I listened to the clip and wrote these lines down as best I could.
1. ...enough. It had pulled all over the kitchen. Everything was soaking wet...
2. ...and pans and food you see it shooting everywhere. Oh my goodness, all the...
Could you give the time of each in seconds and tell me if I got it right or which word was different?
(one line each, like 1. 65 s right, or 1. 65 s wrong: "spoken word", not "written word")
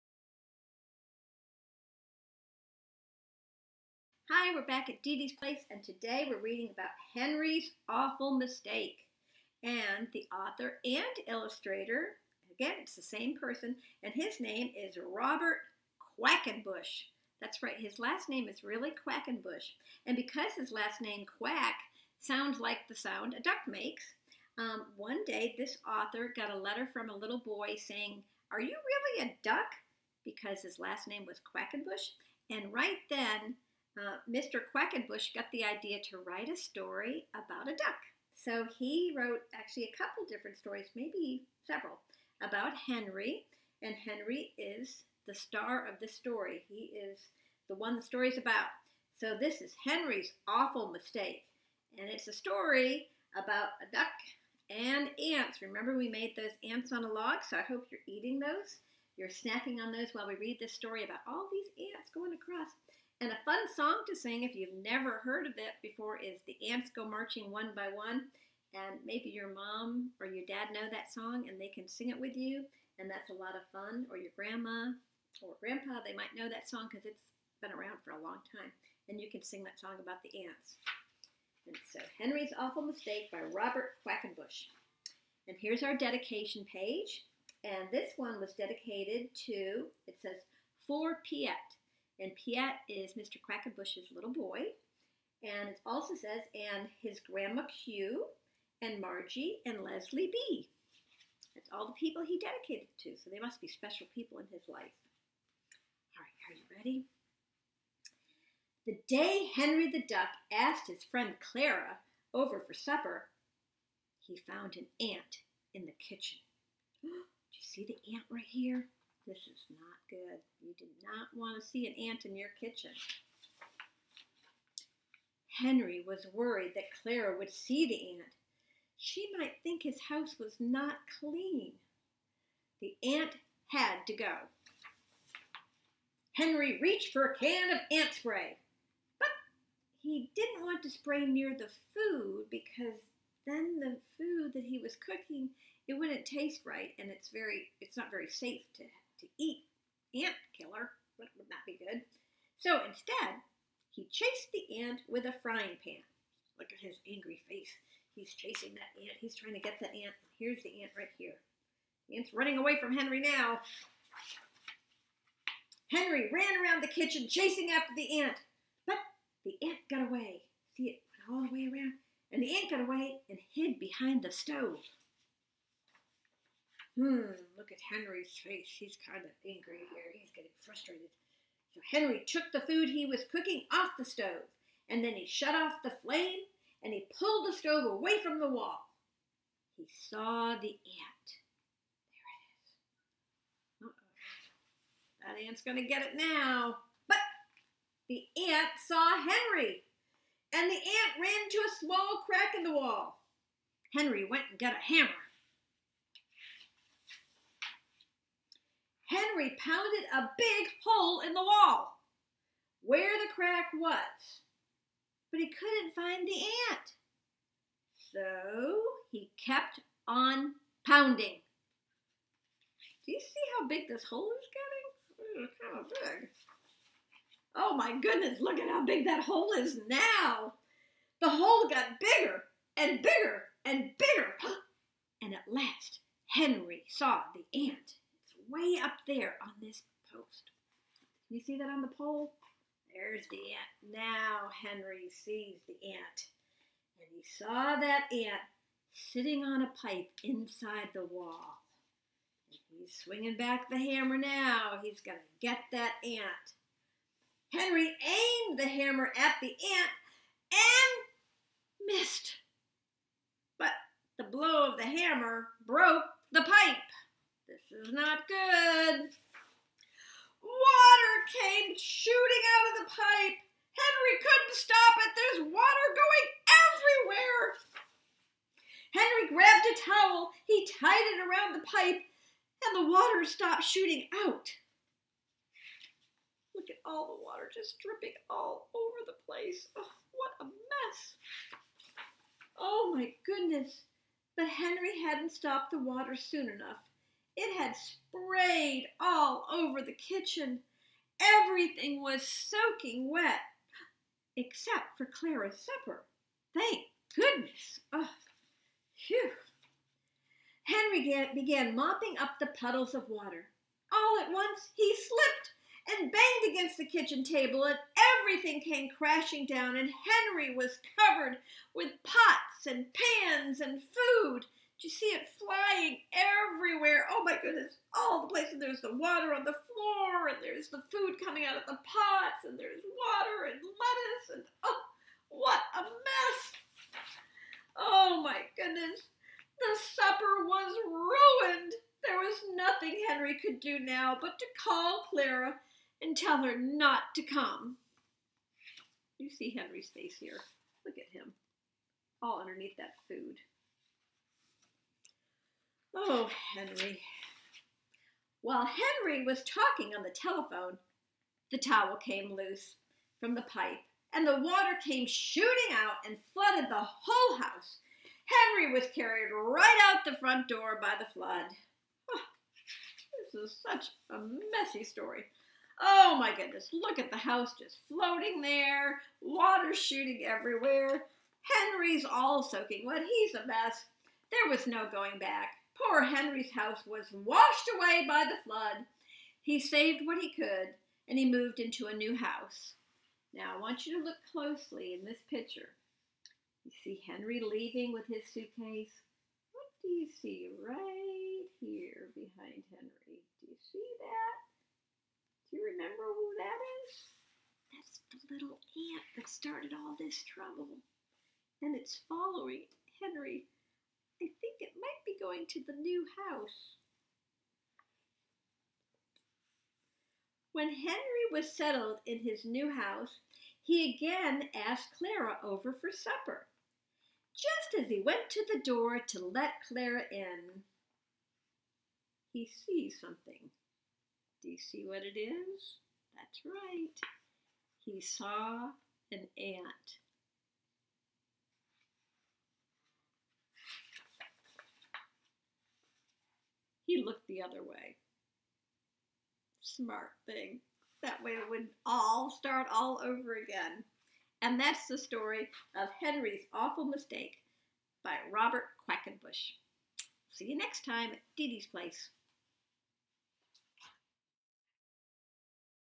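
1. 296 s wrong: "sprayed", not "pulled"
2. 322 s wrong: "flying", not "shooting".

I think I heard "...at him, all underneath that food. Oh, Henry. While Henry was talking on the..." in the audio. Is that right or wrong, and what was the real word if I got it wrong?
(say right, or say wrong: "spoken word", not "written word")
right.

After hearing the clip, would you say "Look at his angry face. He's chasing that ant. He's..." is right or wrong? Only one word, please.
right.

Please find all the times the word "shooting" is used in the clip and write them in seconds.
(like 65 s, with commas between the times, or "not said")
271 s, 283 s, 365 s, 379 s.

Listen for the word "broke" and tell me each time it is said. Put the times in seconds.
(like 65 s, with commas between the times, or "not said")
265 s.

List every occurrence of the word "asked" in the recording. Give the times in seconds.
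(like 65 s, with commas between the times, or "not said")
110 s, 424 s.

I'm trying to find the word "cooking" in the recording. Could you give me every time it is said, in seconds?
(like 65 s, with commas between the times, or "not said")
144 s, 183 s.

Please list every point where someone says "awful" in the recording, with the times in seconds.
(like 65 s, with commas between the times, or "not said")
7 s, 50 s, 82 s, 456 s.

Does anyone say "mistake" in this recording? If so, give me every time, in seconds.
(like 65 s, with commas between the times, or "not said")
8 s, 50 s, 82 s, 456 s.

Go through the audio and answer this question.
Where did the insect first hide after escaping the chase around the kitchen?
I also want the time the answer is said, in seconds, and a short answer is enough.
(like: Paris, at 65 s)
behind the stove, at 173 s.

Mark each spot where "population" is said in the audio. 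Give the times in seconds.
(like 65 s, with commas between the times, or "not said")
not said.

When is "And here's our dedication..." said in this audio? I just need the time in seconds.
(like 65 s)
85 s.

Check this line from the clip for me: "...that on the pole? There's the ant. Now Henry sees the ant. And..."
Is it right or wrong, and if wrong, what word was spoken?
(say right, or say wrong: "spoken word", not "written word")
right.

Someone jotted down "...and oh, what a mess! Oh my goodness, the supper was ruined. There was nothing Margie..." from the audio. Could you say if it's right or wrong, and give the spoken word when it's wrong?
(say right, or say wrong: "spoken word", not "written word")
wrong: "Henry", not "Margie".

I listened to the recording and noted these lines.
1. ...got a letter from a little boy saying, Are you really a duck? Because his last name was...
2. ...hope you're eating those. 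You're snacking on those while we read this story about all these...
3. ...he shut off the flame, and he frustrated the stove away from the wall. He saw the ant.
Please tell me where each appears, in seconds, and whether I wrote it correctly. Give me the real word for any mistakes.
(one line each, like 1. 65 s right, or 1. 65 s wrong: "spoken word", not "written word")
1. 26 s right
2. 57 s right
3. 185 s wrong: "pulled", not "frustrated".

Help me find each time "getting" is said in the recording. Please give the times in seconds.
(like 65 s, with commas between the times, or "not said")
180 s, 224 s.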